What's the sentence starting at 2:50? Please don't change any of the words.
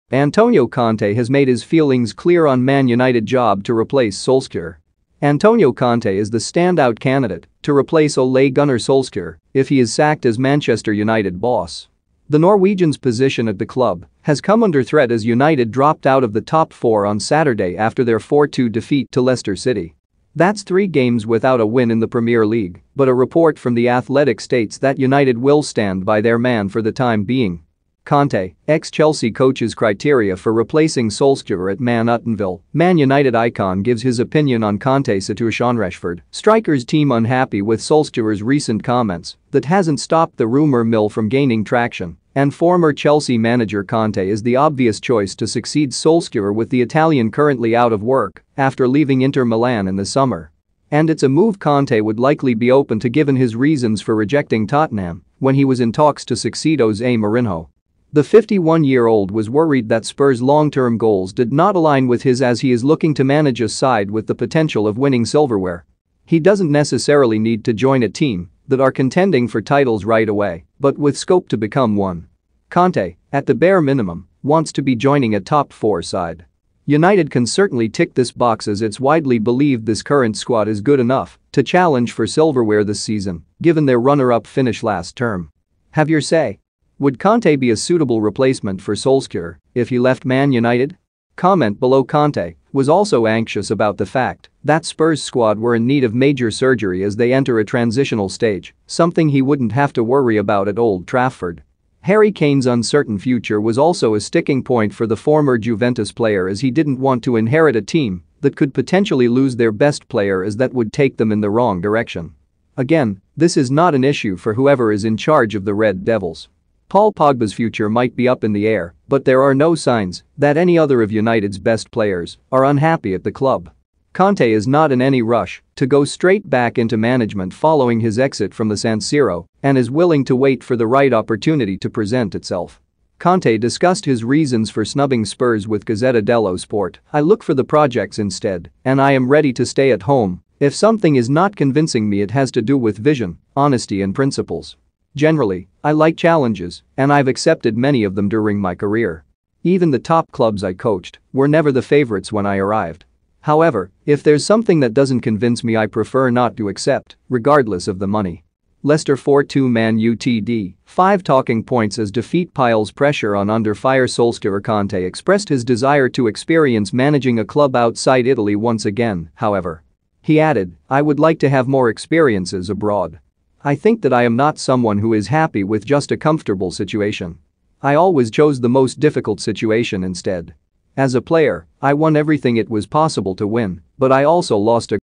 He added, I would like to have more experiences abroad.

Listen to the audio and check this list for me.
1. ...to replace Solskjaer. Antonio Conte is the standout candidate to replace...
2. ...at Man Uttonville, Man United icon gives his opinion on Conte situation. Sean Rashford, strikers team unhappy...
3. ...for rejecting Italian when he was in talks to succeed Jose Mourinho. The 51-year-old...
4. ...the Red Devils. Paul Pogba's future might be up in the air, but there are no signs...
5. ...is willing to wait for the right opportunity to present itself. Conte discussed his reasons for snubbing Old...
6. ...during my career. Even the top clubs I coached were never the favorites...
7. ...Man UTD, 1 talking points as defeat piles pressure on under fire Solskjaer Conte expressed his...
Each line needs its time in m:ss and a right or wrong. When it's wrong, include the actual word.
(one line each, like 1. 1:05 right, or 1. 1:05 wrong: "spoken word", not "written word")
1. 0:03 right
2. 0:31 right
3. 0:54 wrong: "Tottenham", not "Italian"
4. 1:55 right
5. 2:09 wrong: "Spurs", not "Old"
6. 2:28 right
7. 2:39 wrong: "5", not "1".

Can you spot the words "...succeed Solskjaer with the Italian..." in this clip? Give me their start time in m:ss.
0:45.